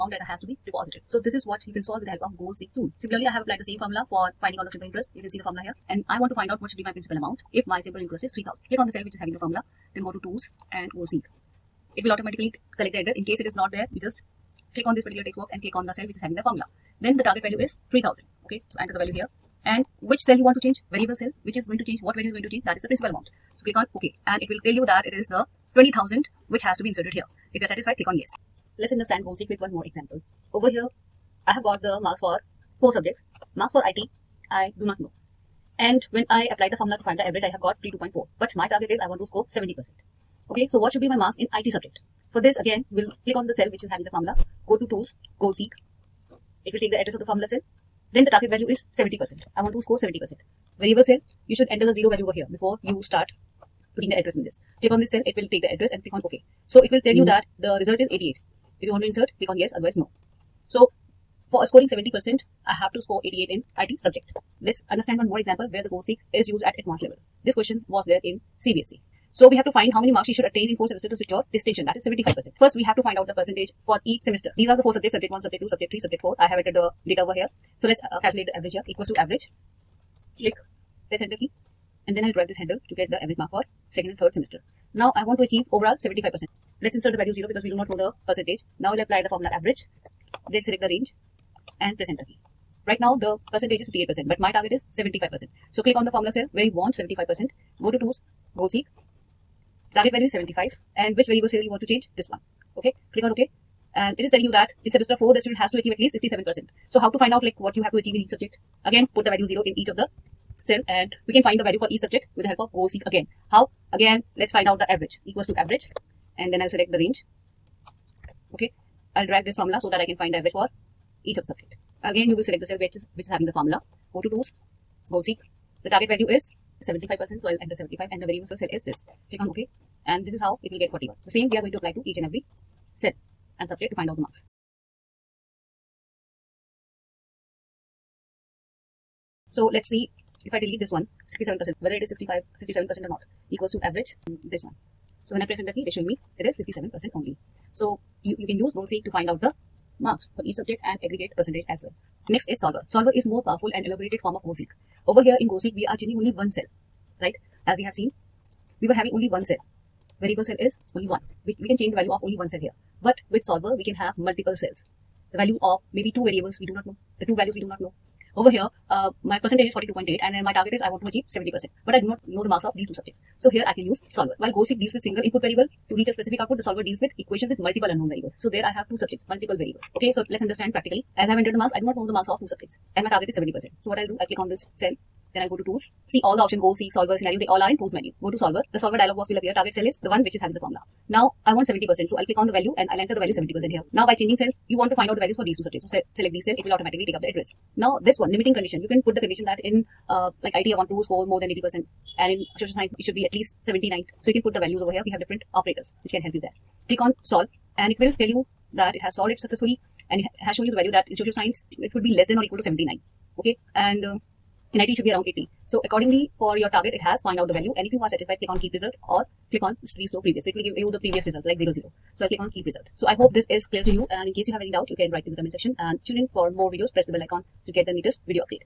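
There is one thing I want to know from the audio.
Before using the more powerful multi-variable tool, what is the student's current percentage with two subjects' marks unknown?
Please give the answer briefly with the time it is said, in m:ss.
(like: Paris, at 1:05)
42.8, at 2:49.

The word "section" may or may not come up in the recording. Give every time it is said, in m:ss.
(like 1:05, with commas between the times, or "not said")
3:45.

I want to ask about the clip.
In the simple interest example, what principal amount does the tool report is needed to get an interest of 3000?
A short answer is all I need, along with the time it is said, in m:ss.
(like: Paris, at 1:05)
20000, at 0:25.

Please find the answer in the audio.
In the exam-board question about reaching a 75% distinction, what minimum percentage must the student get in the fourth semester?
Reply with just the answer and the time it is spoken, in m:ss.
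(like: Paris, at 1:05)
67 percent, at 1:46.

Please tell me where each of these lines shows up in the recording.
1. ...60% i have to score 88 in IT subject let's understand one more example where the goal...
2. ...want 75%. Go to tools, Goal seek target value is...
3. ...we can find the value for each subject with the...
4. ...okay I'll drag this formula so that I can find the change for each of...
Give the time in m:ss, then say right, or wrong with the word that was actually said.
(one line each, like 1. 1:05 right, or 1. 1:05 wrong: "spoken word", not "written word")
1. 1:01 wrong: "70", not "60"
2. 1:36 right
3. 1:51 right
4. 1:58 wrong: "average", not "change".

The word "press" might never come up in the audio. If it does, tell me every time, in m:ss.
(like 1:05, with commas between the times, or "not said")
1:21, 1:31, 2:25, 3:46.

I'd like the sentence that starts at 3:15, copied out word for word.
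So se select these cell, it will automatically take up the address.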